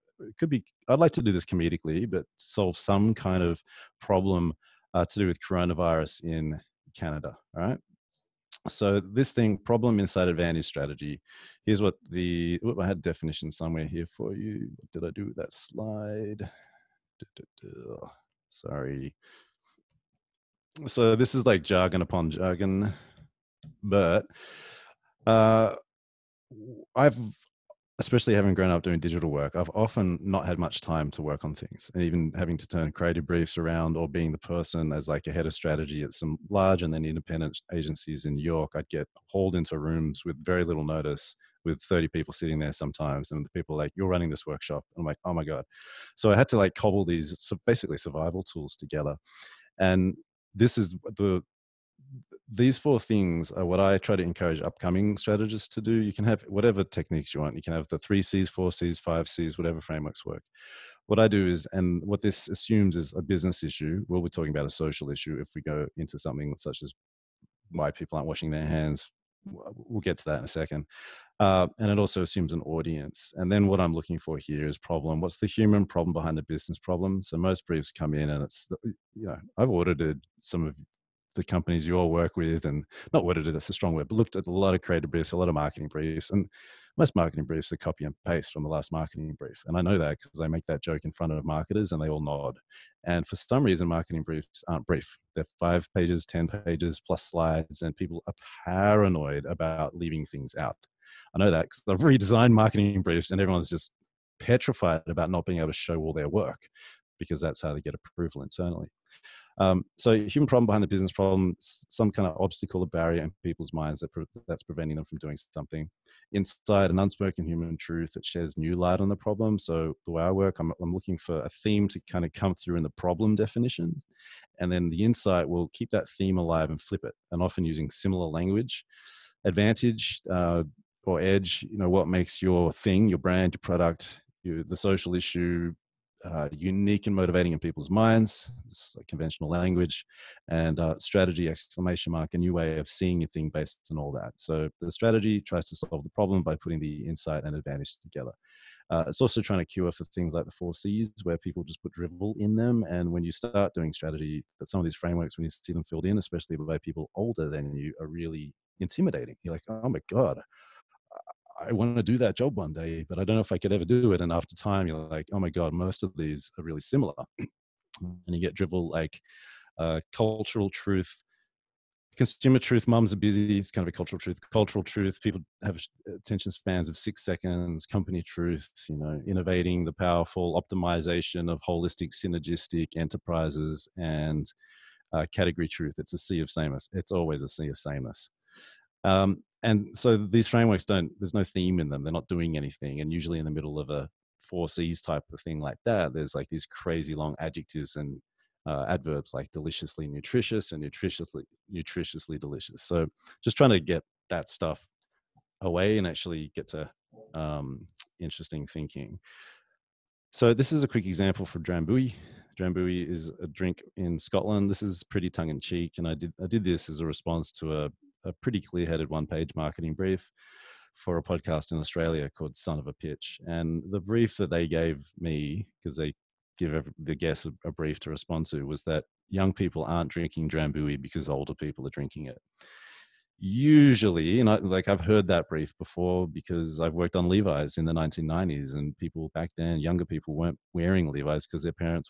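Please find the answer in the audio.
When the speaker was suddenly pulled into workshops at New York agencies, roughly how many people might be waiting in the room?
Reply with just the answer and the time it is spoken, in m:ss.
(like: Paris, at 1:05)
30, at 0:41.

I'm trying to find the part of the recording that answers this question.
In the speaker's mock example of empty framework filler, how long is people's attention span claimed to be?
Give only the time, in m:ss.
2:56.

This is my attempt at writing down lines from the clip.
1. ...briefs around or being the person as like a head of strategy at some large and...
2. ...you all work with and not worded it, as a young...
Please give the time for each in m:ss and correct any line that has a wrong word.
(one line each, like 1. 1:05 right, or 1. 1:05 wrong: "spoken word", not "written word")
1. 0:33 right
2. 1:21 wrong: "strong", not "young".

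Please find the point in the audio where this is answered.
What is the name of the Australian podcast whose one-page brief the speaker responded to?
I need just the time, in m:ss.
3:42.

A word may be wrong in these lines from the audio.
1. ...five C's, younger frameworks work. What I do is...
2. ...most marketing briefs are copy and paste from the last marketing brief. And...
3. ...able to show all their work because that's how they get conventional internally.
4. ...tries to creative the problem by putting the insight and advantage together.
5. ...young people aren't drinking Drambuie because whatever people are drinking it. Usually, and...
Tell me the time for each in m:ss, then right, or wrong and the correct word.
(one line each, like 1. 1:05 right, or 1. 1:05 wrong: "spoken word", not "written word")
1. 0:59 wrong: "whatever", not "younger"
2. 1:26 right
3. 1:45 wrong: "approval", not "conventional"
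4. 2:25 wrong: "solve", not "creative"
5. 3:49 wrong: "older", not "whatever".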